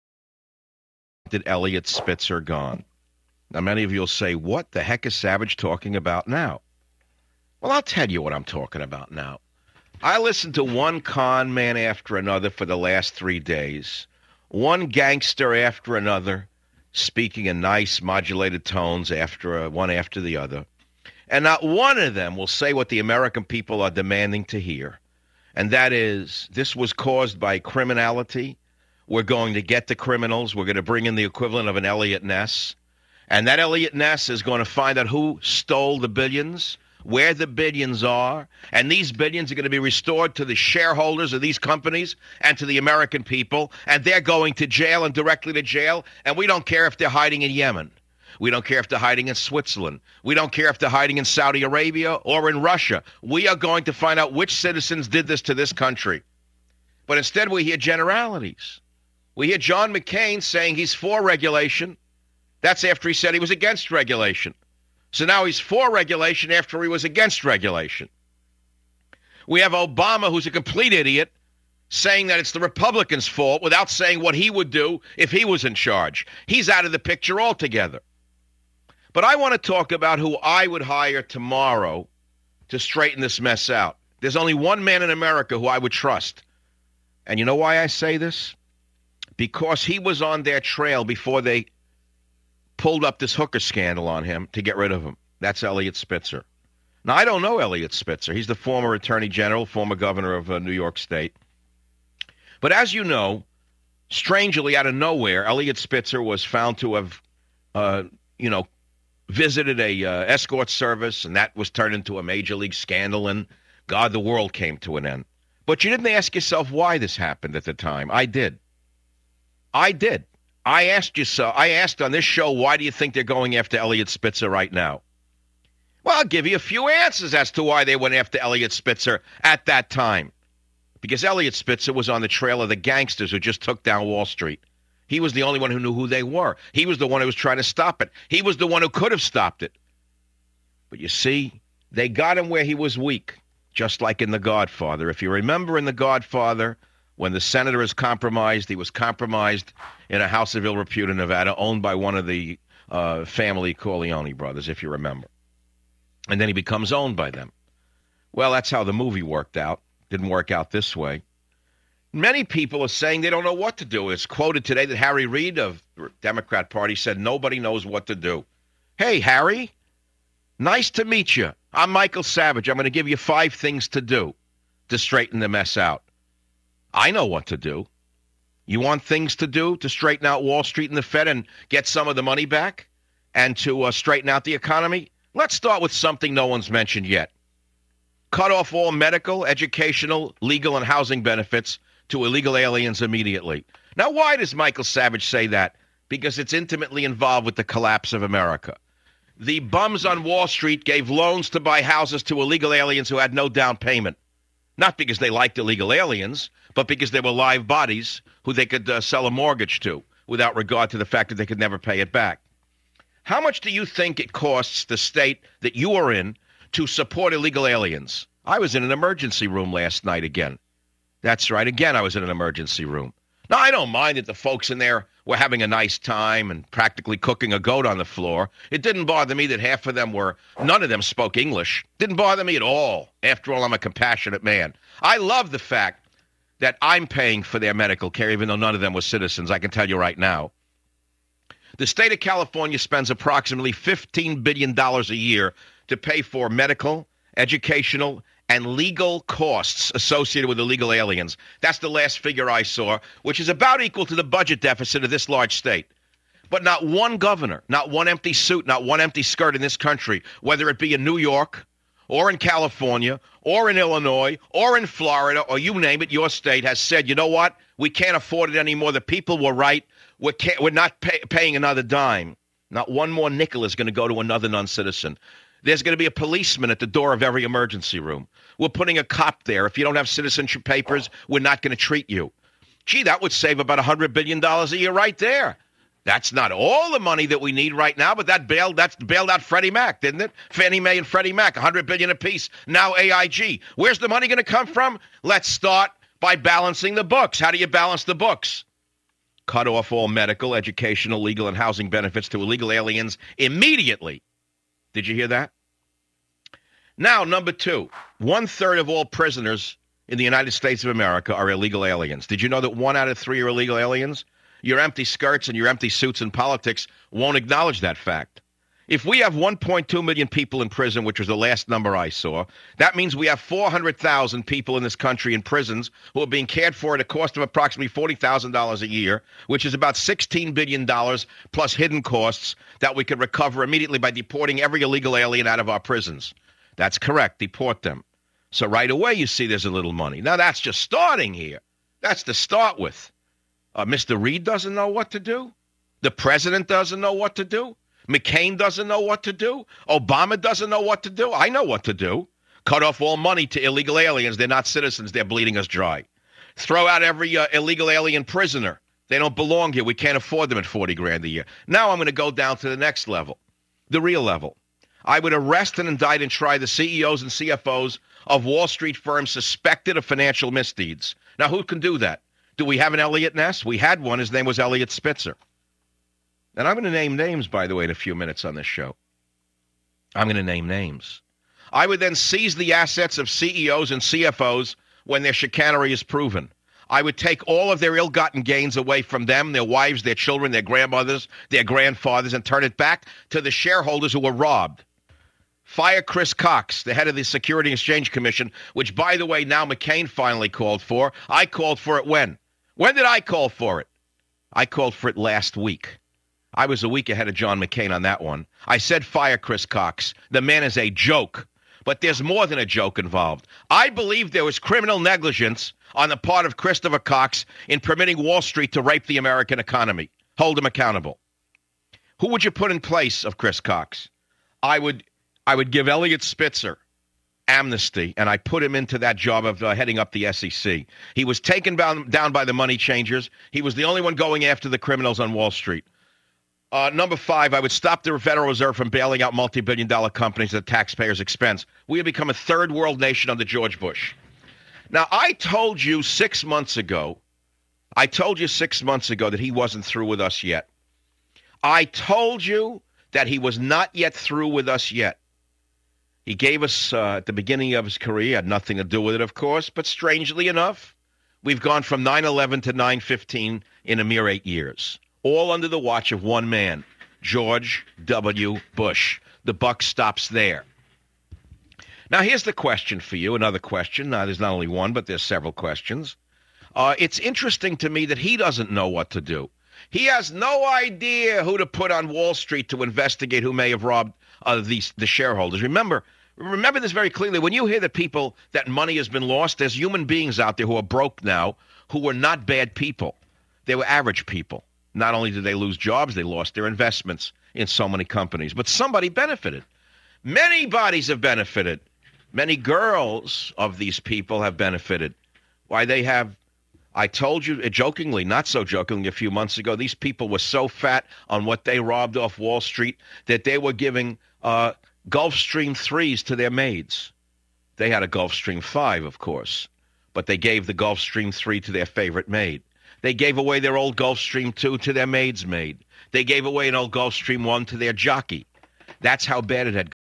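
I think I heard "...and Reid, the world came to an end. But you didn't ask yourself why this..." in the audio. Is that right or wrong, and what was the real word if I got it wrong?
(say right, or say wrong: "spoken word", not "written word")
wrong: "God", not "Reid".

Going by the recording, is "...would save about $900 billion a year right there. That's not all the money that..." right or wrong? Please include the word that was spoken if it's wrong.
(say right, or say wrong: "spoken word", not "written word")
wrong: "100", not "900".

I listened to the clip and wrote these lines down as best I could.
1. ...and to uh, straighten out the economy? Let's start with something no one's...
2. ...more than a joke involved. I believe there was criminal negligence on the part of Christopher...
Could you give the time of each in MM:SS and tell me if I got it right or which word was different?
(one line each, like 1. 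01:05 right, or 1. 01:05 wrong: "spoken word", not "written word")
1. 03:03 right
2. 06:52 right.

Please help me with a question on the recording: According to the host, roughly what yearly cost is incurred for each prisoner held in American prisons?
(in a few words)
$40,000.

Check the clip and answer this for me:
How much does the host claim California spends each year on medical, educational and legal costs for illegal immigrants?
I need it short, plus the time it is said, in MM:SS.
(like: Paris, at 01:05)
$15 billion, at 04:03.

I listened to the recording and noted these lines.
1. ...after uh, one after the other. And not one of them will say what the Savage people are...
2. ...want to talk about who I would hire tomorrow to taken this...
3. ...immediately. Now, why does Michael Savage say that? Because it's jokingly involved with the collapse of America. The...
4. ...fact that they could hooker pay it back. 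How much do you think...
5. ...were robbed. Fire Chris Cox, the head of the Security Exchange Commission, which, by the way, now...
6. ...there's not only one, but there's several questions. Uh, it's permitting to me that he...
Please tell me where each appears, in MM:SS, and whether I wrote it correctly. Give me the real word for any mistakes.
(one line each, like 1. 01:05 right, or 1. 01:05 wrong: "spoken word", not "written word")
1. 00:19 wrong: "American", not "Savage"
2. 01:19 wrong: "straighten", not "taken"
3. 03:13 wrong: "intimately", not "jokingly"
4. 03:31 wrong: "never", not "hooker"
5. 06:34 right
6. 07:54 wrong: "interesting", not "permitting".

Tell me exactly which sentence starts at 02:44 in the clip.
It's quoted today that Harry Reid of the Democrat Party said nobody knows what to do.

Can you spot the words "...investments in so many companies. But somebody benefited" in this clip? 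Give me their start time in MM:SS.
08:16.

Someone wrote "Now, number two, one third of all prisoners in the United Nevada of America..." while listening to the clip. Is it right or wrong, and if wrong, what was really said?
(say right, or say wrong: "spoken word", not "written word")
wrong: "States", not "Nevada".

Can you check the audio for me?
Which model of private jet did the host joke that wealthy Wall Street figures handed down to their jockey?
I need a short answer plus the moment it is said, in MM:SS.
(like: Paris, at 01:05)
Gulfstream 1, at 08:46.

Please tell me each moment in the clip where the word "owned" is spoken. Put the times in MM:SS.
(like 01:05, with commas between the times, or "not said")
02:31, 02:36.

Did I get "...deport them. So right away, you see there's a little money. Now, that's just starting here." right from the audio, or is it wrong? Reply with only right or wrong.
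right.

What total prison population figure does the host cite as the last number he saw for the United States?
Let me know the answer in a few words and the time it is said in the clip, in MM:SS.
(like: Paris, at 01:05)
1.2 million, at 05:19.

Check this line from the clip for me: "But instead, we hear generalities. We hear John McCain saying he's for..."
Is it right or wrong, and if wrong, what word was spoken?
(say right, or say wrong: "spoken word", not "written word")
right.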